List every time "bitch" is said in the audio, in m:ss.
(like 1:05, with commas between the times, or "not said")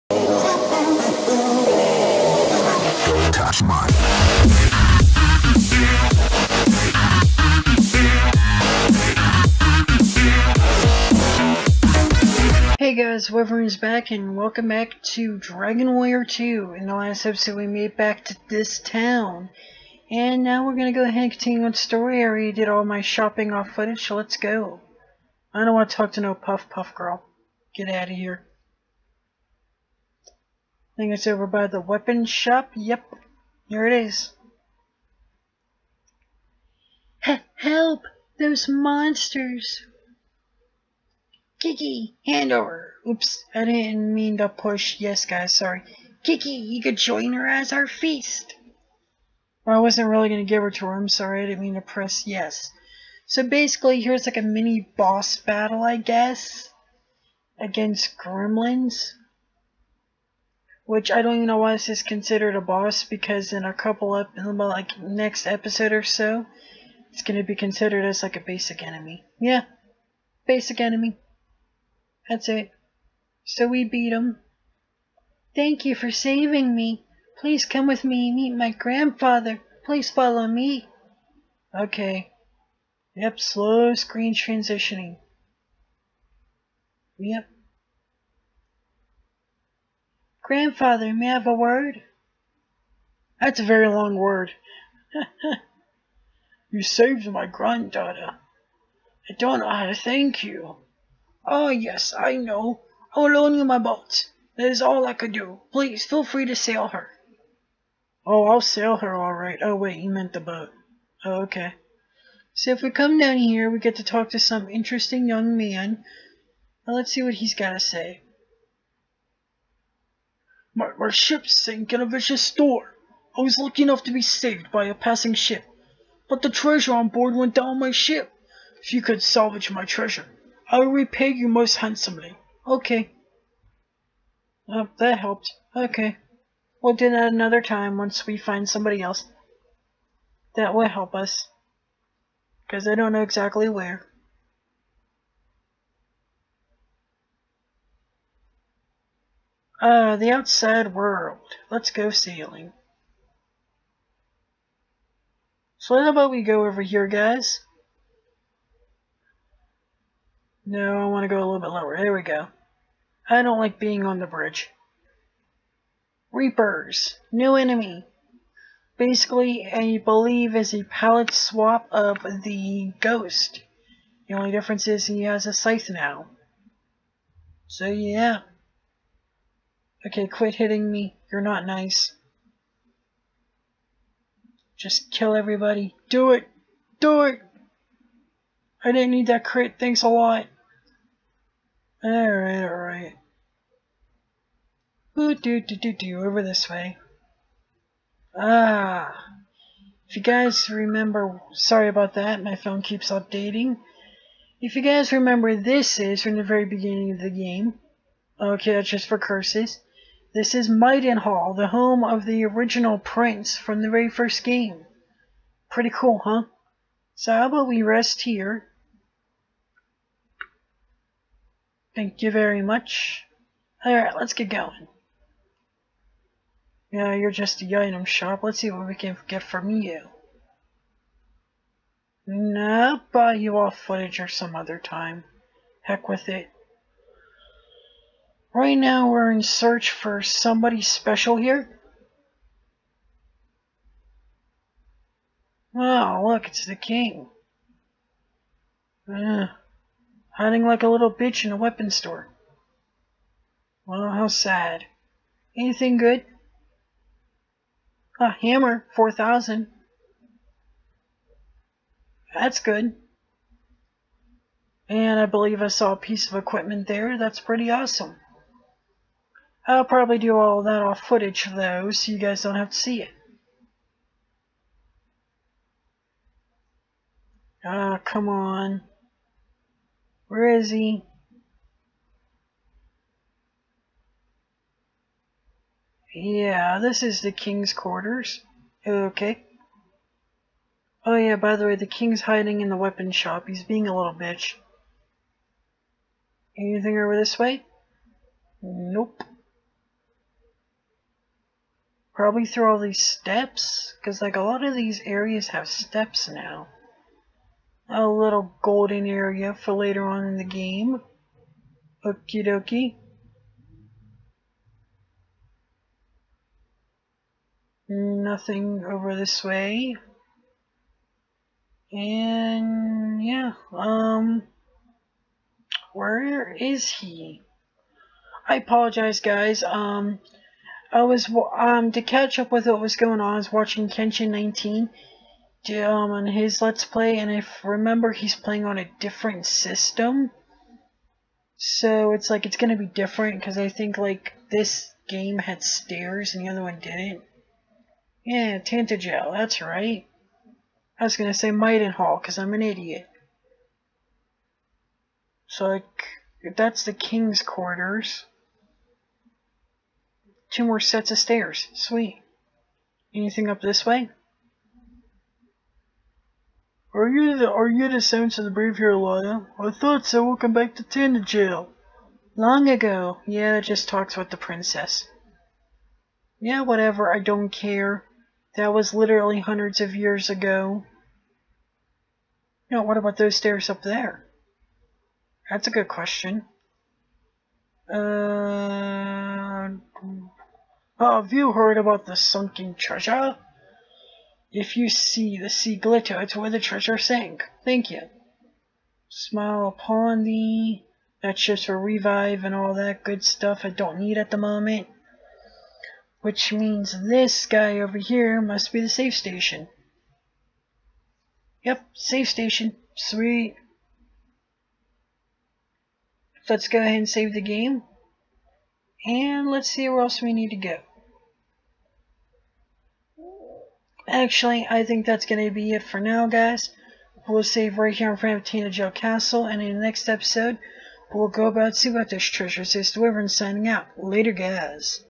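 4:11, 4:54.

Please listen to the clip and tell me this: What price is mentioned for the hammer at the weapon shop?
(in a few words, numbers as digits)
4,000.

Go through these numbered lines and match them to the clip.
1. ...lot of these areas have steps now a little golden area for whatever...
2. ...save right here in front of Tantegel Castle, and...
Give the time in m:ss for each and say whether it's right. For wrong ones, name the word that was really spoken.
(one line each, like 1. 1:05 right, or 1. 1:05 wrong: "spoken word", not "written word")
1. 5:04 wrong: "later", not "whatever"
2. 7:07 right.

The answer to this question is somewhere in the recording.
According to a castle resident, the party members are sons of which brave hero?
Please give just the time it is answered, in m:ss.
6:08.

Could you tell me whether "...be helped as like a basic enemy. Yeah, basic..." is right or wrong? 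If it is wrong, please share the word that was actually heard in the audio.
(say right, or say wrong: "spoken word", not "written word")
wrong: "considered", not "helped".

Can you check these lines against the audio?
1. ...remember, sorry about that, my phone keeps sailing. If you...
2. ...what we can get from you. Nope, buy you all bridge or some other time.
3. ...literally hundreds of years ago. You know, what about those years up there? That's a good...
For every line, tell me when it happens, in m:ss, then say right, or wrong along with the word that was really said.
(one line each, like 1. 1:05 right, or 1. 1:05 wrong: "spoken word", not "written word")
1. 3:20 wrong: "updating", not "sailing"
2. 3:48 wrong: "footage", not "bridge"
3. 6:18 wrong: "stairs", not "years".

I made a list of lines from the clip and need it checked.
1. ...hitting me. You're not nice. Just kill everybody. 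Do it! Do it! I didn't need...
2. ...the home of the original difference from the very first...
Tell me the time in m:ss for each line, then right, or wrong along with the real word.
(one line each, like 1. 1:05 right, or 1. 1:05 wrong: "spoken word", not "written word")
1. 3:00 right
2. 3:31 wrong: "prince", not "difference".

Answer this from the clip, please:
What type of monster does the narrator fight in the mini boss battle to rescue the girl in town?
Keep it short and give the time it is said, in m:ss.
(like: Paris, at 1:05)
Gremlins, at 0:58.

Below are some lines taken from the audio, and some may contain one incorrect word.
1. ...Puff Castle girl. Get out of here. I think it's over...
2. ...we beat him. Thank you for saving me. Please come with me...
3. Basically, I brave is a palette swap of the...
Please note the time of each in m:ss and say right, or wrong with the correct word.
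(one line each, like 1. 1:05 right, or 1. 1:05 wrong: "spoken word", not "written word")
1. 0:26 wrong: "Puff", not "Castle"
2. 1:13 right
3. 2:48 wrong: "believe", not "brave".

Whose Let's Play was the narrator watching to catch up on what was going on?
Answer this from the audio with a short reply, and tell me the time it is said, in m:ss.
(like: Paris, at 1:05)
Kenshin 19, at 5:33.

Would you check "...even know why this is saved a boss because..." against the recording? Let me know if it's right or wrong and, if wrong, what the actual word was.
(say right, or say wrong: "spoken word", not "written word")
wrong: "considered", not "saved".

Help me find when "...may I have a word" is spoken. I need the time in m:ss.
1:31.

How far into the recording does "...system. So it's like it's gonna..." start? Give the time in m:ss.
5:39.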